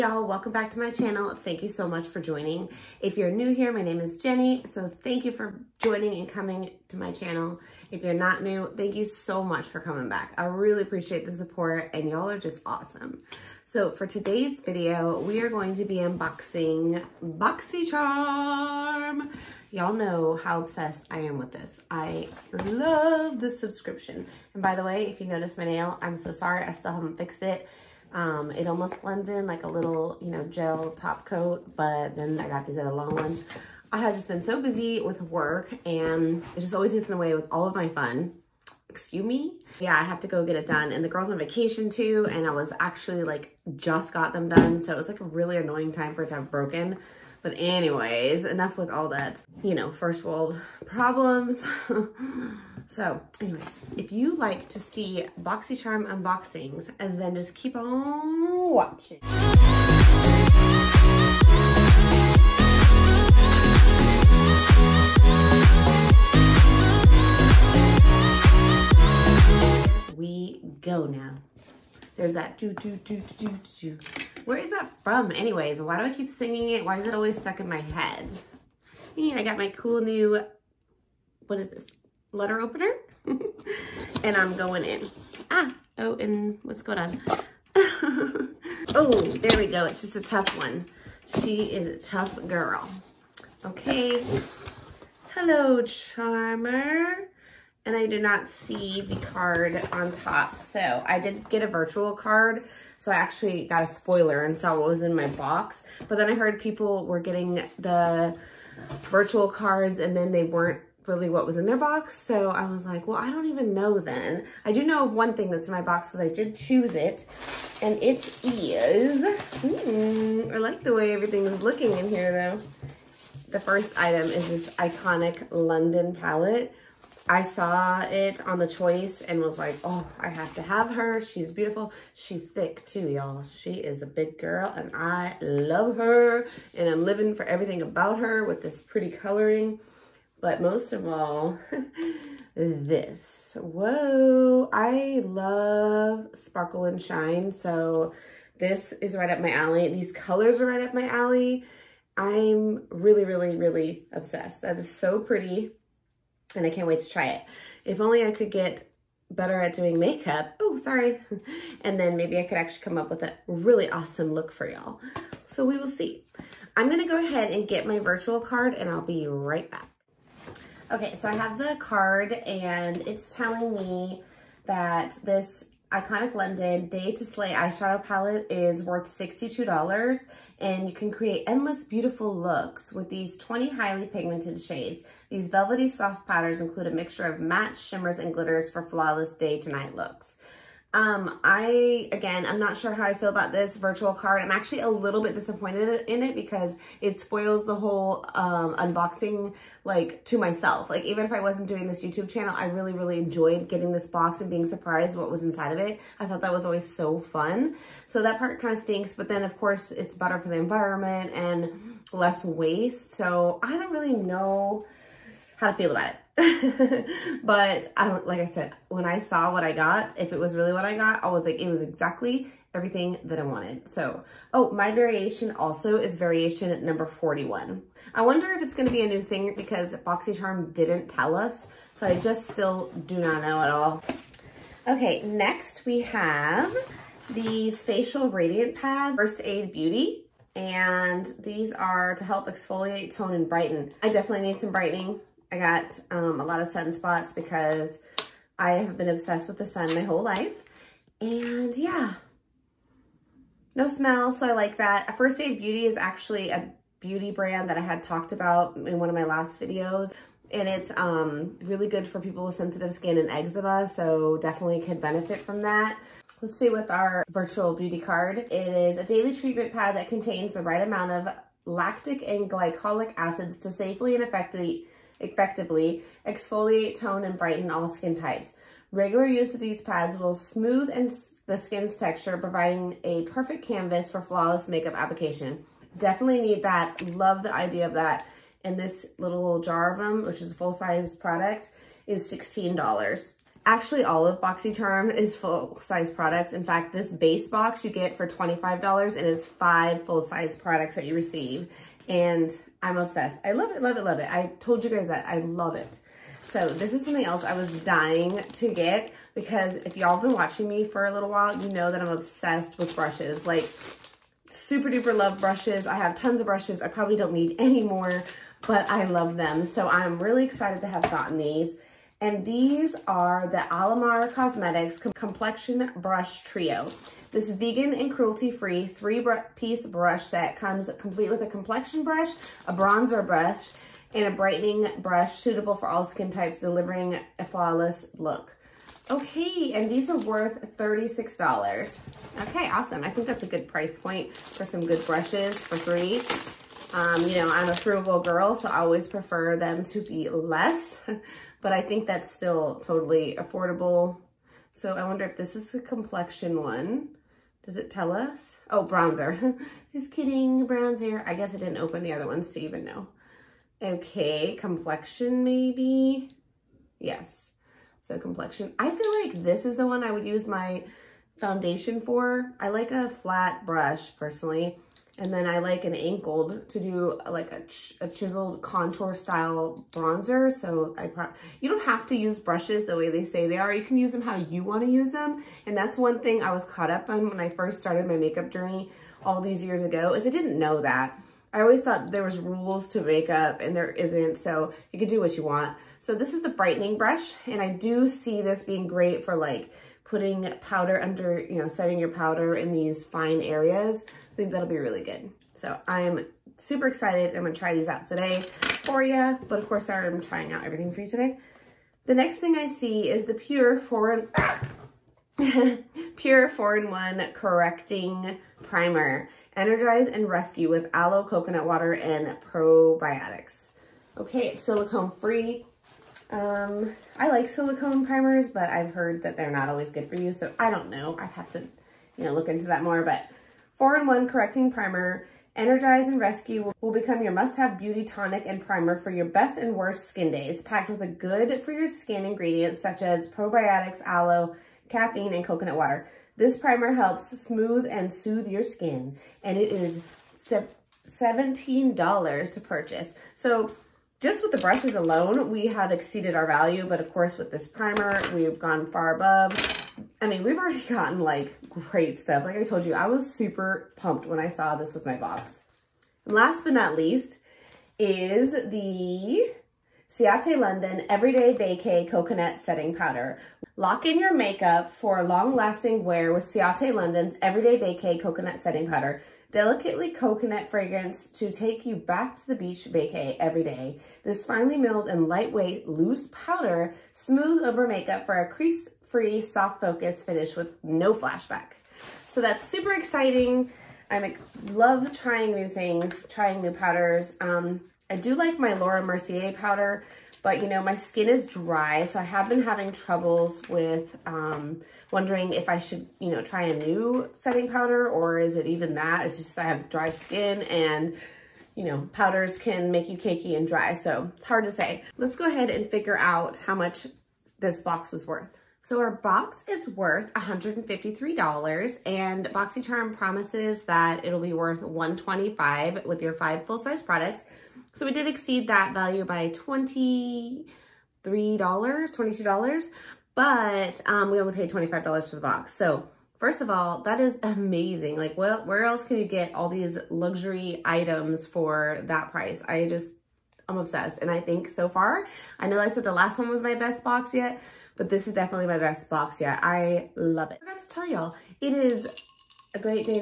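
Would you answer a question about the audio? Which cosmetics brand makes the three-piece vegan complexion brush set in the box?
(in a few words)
Alamar Cosmetics.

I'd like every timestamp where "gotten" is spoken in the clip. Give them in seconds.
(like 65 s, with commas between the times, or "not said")
321 s, 460 s.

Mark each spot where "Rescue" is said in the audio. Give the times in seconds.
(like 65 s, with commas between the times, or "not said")
420 s, 436 s.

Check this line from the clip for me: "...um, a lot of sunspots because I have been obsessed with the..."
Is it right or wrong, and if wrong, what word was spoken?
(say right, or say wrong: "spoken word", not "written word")
right.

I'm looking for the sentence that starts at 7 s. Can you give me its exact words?
If you're not new, thank you so much for coming back.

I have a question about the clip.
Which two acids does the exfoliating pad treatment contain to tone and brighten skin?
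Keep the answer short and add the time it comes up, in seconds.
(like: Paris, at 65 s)
lactic and glycolic, at 271 s.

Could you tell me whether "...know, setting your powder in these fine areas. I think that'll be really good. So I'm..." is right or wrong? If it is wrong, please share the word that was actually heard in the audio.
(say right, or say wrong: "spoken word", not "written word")
right.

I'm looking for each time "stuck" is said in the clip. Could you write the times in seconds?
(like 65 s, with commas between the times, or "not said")
77 s.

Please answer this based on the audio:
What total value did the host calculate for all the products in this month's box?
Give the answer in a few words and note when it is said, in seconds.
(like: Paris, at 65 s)
$153, at 520 s.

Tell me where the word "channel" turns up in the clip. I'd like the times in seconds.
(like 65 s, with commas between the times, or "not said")
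0 s, 7 s, 202 s.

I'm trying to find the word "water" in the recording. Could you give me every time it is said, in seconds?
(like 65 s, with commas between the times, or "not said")
421 s, 445 s.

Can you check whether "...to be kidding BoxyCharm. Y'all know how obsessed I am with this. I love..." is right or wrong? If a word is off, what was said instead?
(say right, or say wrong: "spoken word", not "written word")
wrong: "unboxing", not "kidding".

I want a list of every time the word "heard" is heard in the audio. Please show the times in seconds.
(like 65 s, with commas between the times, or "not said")
106 s, 428 s.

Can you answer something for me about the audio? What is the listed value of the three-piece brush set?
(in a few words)
$36.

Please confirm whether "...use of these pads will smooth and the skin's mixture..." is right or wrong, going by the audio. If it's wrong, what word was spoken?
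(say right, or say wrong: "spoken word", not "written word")
wrong: "texture", not "mixture".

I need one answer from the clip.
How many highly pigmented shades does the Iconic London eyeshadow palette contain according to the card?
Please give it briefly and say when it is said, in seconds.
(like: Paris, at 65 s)
20, at 183 s.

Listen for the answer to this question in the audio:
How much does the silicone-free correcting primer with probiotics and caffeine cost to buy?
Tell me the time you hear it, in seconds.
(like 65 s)
451 s.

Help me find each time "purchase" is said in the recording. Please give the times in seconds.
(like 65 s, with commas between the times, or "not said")
452 s.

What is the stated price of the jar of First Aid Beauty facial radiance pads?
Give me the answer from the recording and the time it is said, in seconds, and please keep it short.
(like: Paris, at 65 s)
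$16, at 292 s.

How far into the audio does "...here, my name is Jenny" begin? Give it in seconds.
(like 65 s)
3 s.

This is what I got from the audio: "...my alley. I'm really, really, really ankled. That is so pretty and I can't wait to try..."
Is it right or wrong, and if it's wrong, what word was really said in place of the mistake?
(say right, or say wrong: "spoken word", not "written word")
wrong: "obsessed", not "ankled".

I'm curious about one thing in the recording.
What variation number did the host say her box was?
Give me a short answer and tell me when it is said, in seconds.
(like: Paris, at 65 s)
41, at 227 s.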